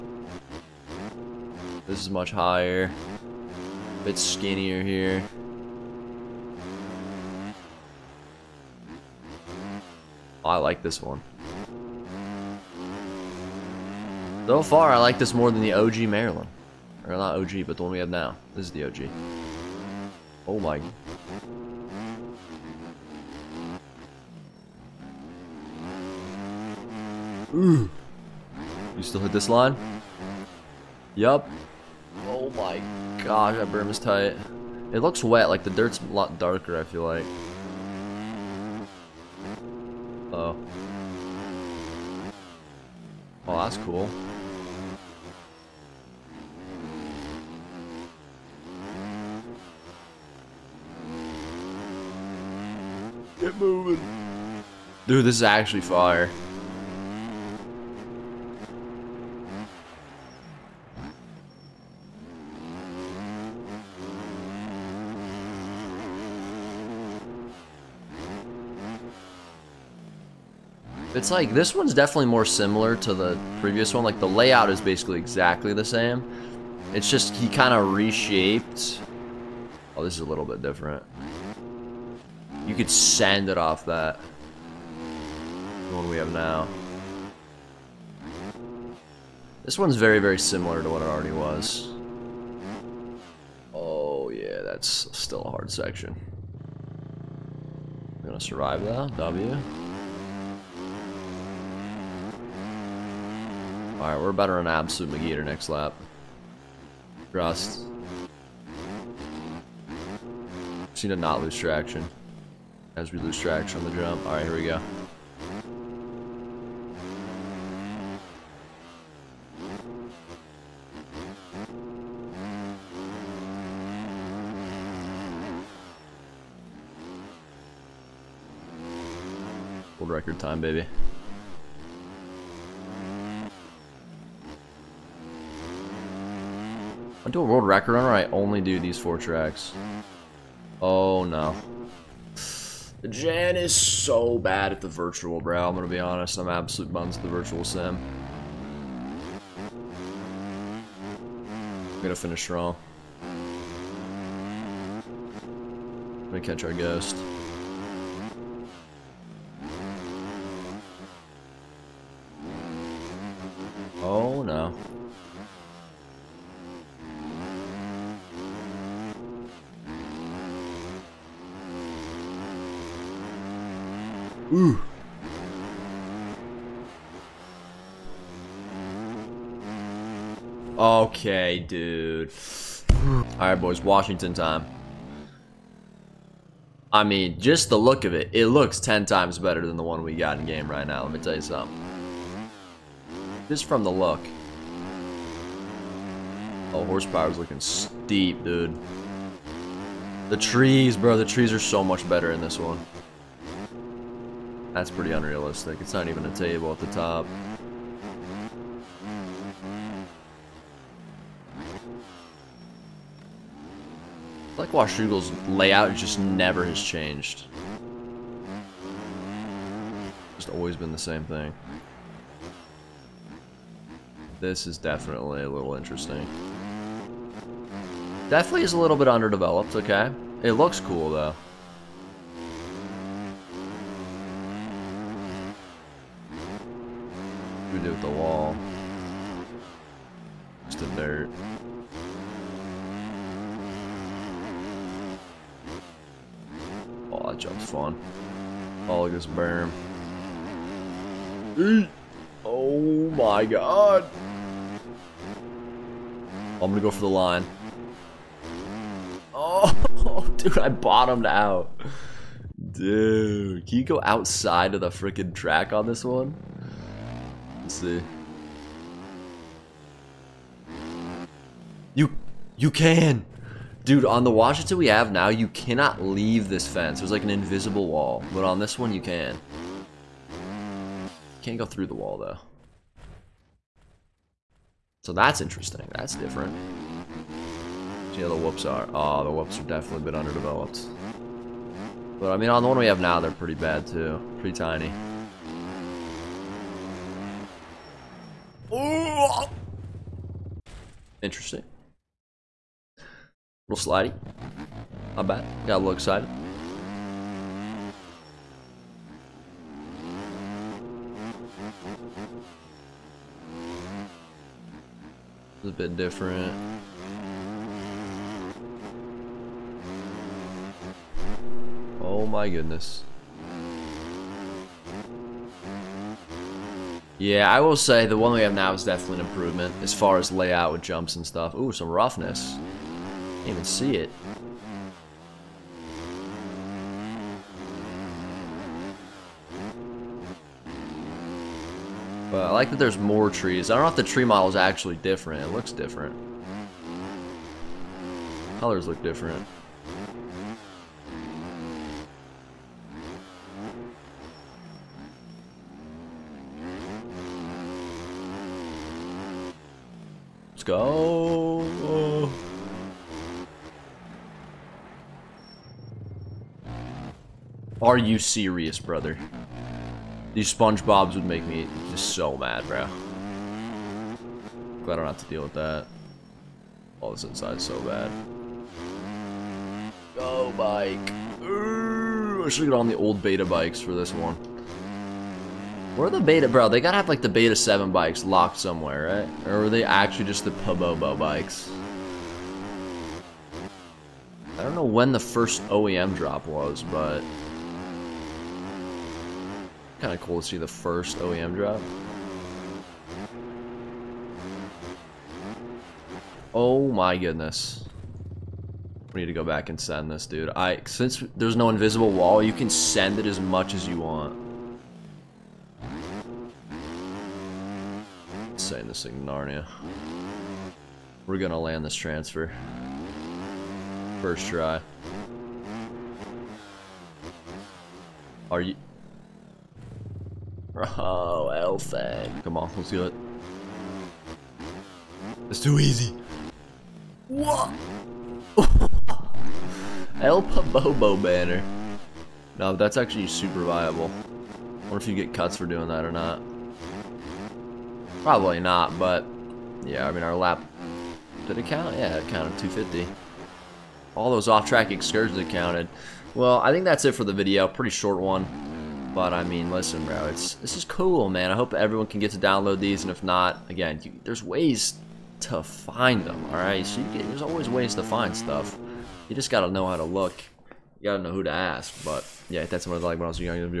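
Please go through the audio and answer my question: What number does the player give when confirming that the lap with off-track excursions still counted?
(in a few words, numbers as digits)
250.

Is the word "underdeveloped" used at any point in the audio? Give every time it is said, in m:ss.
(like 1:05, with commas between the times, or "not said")
3:49, 4:50.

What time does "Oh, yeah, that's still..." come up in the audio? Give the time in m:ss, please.
1:33.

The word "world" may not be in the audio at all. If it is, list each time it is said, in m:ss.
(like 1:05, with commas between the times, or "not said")
2:09, 2:17.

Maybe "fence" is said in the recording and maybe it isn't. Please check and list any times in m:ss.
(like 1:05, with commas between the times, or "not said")
4:36.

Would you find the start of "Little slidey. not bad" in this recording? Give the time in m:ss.
5:03.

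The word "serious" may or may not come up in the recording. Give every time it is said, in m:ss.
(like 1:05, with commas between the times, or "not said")
6:08.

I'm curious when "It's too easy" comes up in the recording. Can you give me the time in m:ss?
7:15.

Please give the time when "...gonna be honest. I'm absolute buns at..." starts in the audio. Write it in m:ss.
2:25.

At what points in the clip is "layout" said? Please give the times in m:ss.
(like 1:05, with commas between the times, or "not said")
1:14, 3:35, 5:30.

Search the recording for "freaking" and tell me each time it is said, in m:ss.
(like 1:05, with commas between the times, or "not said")
4:24.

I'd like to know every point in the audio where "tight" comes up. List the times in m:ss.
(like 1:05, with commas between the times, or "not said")
0:33.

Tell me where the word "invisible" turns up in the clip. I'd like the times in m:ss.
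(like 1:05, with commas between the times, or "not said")
4:37, 6:51.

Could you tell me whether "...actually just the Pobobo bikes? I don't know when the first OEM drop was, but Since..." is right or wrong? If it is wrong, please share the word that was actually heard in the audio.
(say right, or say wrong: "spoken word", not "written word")
wrong: "Kind", not "Since".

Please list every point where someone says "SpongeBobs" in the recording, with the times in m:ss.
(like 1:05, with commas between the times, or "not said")
6:10.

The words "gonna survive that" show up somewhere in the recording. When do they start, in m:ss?
1:38.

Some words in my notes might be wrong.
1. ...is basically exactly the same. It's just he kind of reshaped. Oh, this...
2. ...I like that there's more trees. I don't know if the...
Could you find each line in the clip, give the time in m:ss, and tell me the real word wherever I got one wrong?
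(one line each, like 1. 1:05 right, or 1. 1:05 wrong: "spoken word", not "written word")
1. 1:14 right
2. 5:42 right.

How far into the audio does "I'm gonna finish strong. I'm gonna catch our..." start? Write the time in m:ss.
2:31.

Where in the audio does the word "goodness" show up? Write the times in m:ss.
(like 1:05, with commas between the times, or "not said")
5:22, 6:47.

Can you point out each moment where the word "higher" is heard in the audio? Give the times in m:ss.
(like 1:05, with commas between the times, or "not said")
0:02.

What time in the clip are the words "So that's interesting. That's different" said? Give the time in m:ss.
4:45.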